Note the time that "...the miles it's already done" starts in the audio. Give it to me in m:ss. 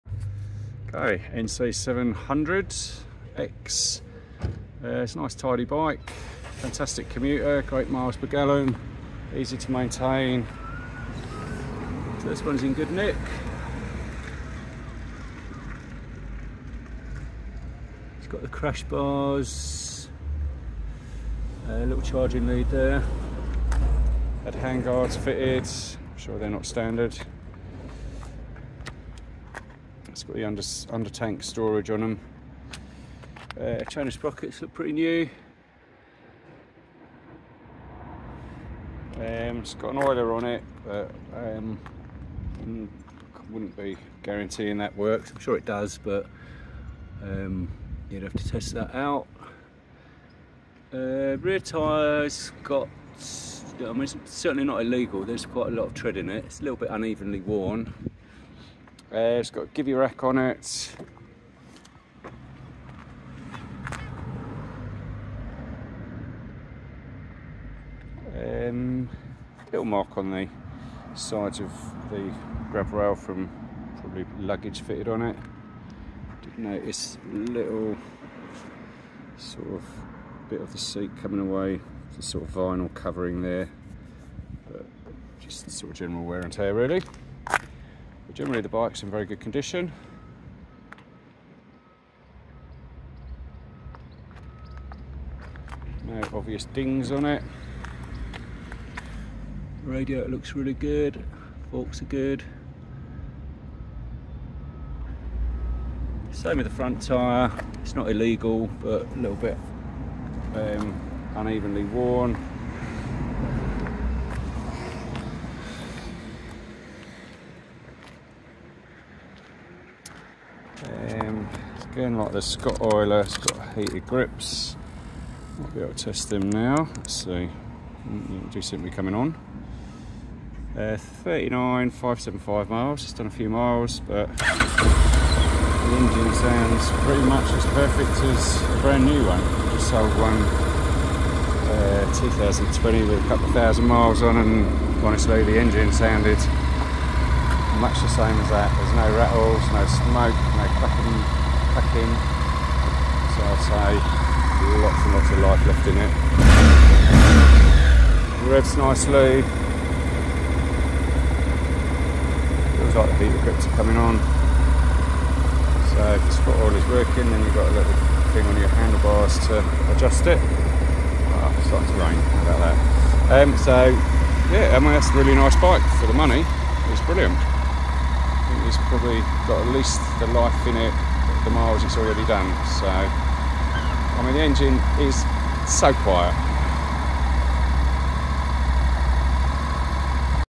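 3:01.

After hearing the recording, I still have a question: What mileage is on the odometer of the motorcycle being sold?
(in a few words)
39,575 miles.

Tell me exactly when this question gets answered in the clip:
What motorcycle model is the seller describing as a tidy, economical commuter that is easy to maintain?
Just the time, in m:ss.
0:01.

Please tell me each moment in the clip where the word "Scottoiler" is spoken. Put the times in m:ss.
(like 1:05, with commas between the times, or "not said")
2:02, 2:46.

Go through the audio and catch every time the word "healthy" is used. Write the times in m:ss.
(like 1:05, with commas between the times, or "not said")
not said.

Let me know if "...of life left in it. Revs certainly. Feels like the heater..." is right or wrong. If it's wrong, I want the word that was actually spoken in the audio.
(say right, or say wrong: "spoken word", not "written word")
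wrong: "nicely", not "certainly".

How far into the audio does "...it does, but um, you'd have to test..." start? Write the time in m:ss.
0:45.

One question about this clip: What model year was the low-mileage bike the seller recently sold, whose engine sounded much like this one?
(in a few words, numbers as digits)
2020.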